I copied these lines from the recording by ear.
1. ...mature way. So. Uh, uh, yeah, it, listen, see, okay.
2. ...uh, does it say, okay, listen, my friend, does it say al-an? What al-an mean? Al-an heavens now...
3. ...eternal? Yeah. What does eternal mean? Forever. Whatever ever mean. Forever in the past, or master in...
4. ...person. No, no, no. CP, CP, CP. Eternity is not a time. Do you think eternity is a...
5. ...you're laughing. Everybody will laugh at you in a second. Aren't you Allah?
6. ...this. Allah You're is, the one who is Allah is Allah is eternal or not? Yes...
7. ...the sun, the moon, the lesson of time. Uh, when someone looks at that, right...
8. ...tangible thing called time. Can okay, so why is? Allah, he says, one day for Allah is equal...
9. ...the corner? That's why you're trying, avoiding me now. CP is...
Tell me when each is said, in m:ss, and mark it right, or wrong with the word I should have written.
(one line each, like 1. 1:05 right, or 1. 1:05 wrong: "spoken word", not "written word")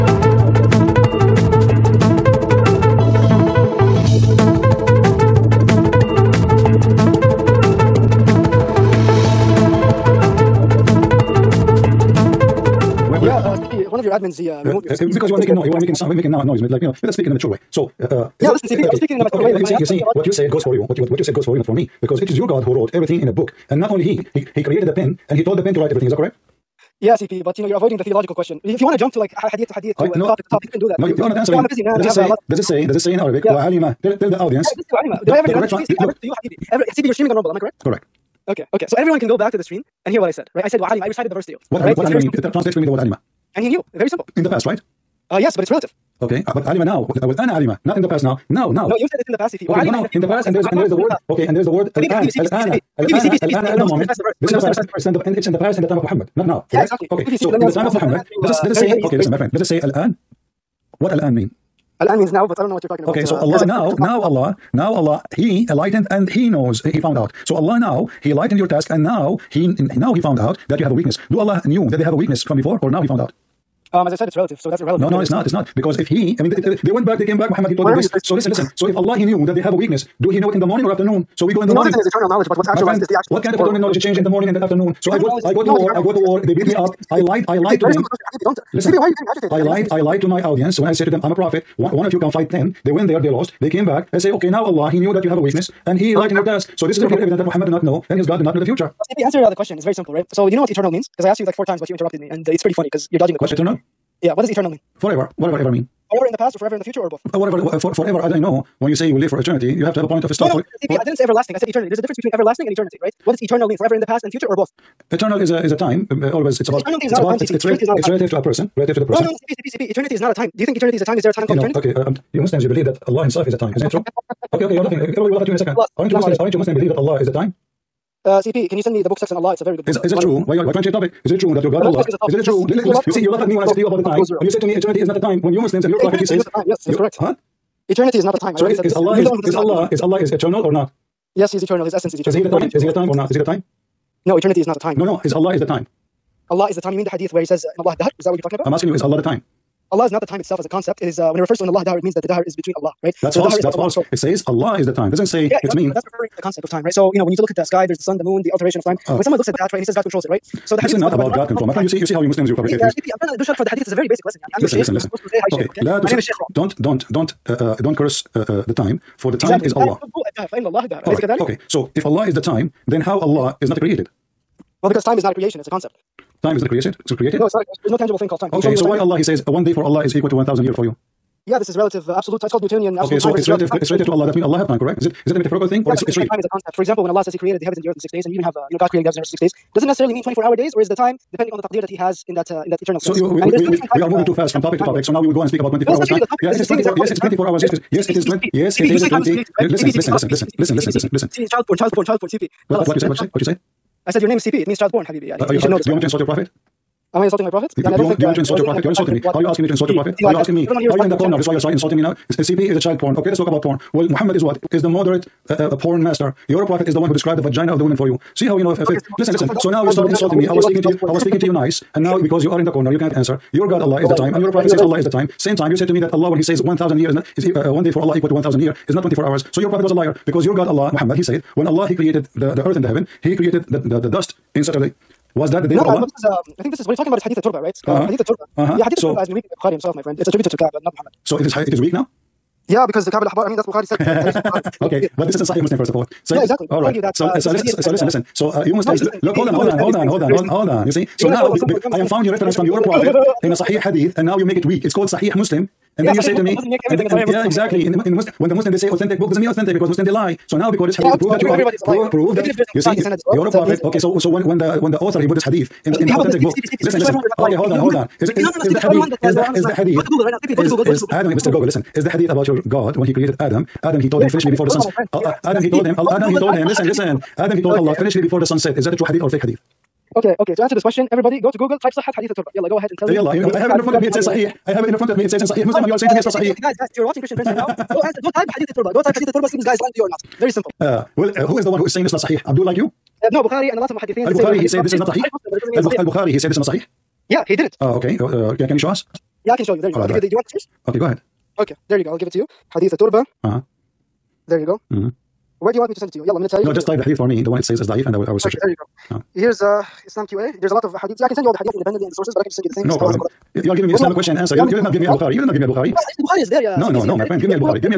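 1. 0:17 right
2. 0:58 wrong: "means", not "heavens"
3. 1:43 wrong: "forever", not "master"
4. 1:59 right
5. 2:04 wrong: "Muslims", not "Allah"
6. 2:18 right
7. 2:38 wrong: "alteration", not "lesson"
8. 2:57 right
9. 3:31 wrong: "insulting", not "avoiding".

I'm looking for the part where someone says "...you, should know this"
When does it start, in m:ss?
3:25.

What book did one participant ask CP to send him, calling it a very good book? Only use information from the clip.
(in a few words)
Sex and Allah.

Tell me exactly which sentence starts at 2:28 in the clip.
I'm asking you, is Allah the time?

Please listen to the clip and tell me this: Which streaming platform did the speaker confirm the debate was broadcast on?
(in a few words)
Rumble.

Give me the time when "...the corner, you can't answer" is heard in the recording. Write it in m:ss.
3:42.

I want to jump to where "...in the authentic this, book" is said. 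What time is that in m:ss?
4:26.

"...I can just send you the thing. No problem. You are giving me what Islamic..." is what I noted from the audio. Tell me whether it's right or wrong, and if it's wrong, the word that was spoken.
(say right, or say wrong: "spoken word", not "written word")
right.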